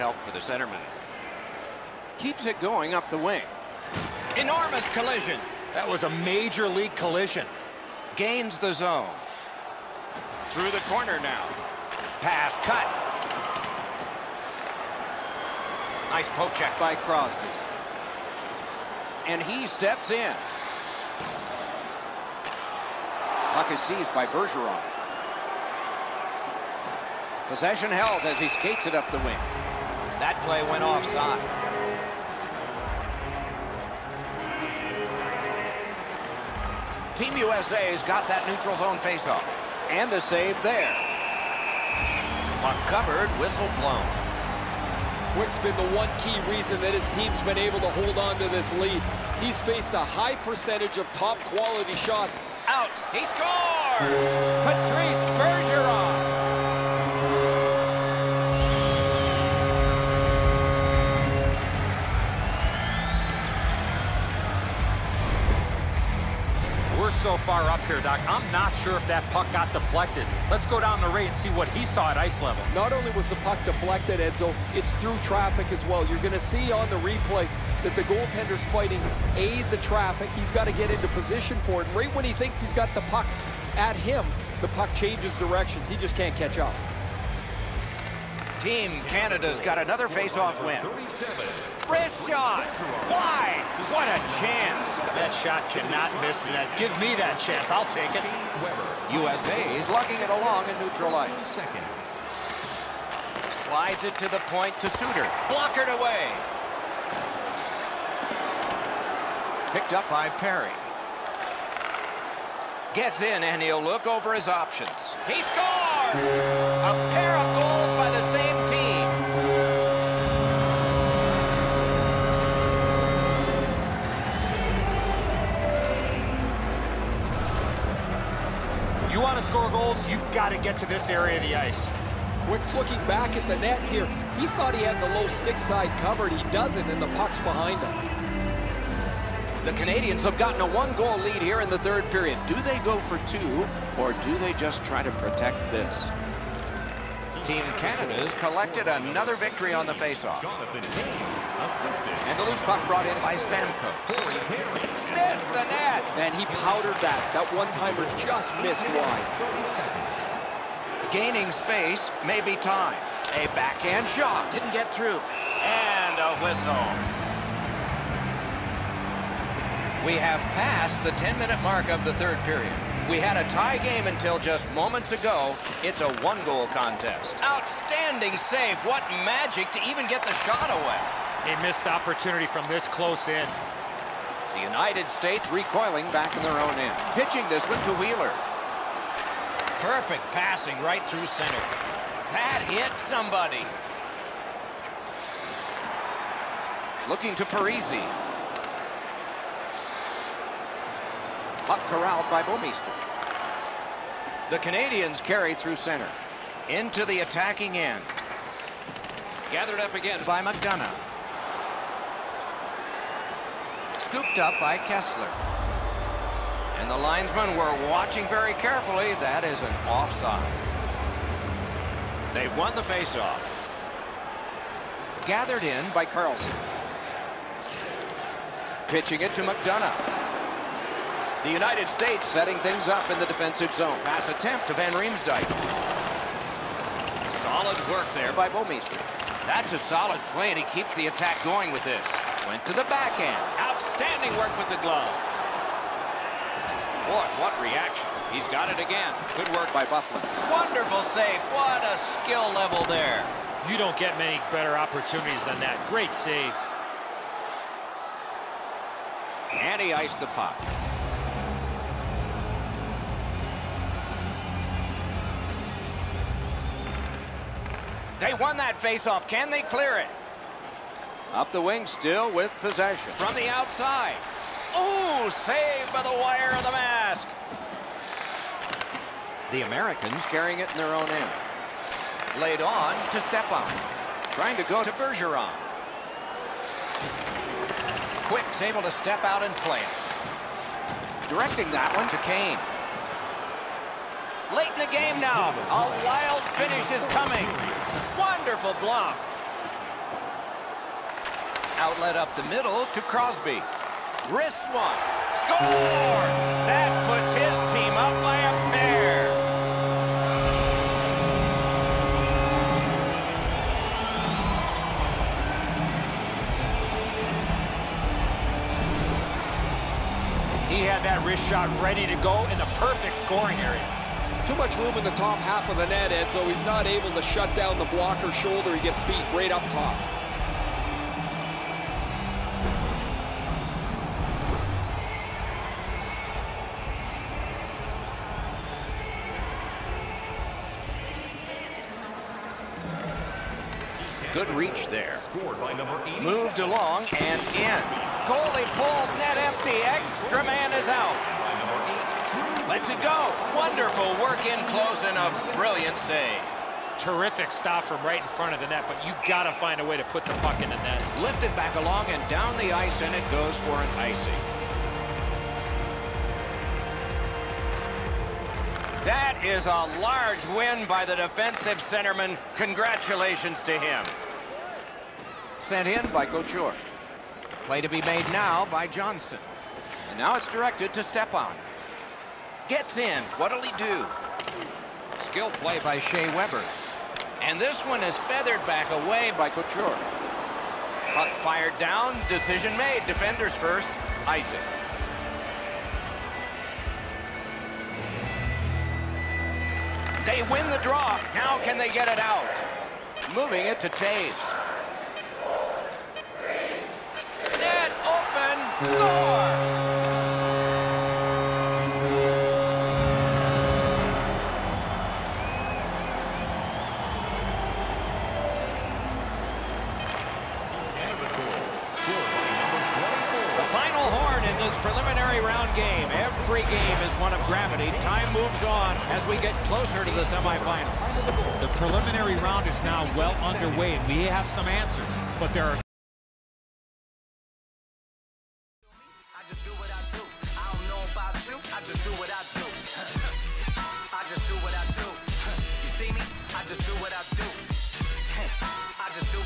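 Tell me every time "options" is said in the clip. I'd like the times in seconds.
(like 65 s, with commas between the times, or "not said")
114 s.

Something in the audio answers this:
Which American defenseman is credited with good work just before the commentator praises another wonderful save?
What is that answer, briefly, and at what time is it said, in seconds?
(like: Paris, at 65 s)
Byfuglien, at 249 s.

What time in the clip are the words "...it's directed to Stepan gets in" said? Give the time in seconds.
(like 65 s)
380 s.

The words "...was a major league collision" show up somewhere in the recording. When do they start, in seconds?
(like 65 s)
5 s.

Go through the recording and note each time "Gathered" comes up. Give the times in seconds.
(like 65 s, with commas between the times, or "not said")
209 s, 225 s.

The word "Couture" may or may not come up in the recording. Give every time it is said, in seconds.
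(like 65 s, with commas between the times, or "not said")
376 s, 389 s.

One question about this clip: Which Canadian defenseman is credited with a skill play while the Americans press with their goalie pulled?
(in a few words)
Shea Weber.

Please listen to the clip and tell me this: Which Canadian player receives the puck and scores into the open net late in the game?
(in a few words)
Toews.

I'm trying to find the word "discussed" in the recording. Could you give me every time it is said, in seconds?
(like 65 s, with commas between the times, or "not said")
not said.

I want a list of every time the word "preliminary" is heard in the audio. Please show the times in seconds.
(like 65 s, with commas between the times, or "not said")
424 s, 431 s.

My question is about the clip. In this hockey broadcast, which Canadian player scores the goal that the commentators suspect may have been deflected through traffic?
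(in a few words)
Patrice Bergeron.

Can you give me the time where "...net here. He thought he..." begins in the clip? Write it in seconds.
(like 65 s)
133 s.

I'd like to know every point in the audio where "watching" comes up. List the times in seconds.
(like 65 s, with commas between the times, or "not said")
217 s.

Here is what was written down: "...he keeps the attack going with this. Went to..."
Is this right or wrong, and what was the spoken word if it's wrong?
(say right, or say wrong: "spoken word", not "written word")
right.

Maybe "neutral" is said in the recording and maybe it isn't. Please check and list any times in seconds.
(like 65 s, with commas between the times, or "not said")
38 s, 100 s.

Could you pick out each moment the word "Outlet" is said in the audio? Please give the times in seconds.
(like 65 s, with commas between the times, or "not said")
301 s.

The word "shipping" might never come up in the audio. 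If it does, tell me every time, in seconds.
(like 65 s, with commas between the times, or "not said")
not said.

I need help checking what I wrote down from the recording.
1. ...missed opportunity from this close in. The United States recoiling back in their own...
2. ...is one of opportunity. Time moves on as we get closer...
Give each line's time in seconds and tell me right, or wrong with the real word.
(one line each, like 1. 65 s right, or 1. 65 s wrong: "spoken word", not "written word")
1. 181 s right
2. 427 s wrong: "gravity", not "opportunity".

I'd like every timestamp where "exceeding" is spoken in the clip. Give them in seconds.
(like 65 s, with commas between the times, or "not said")
not said.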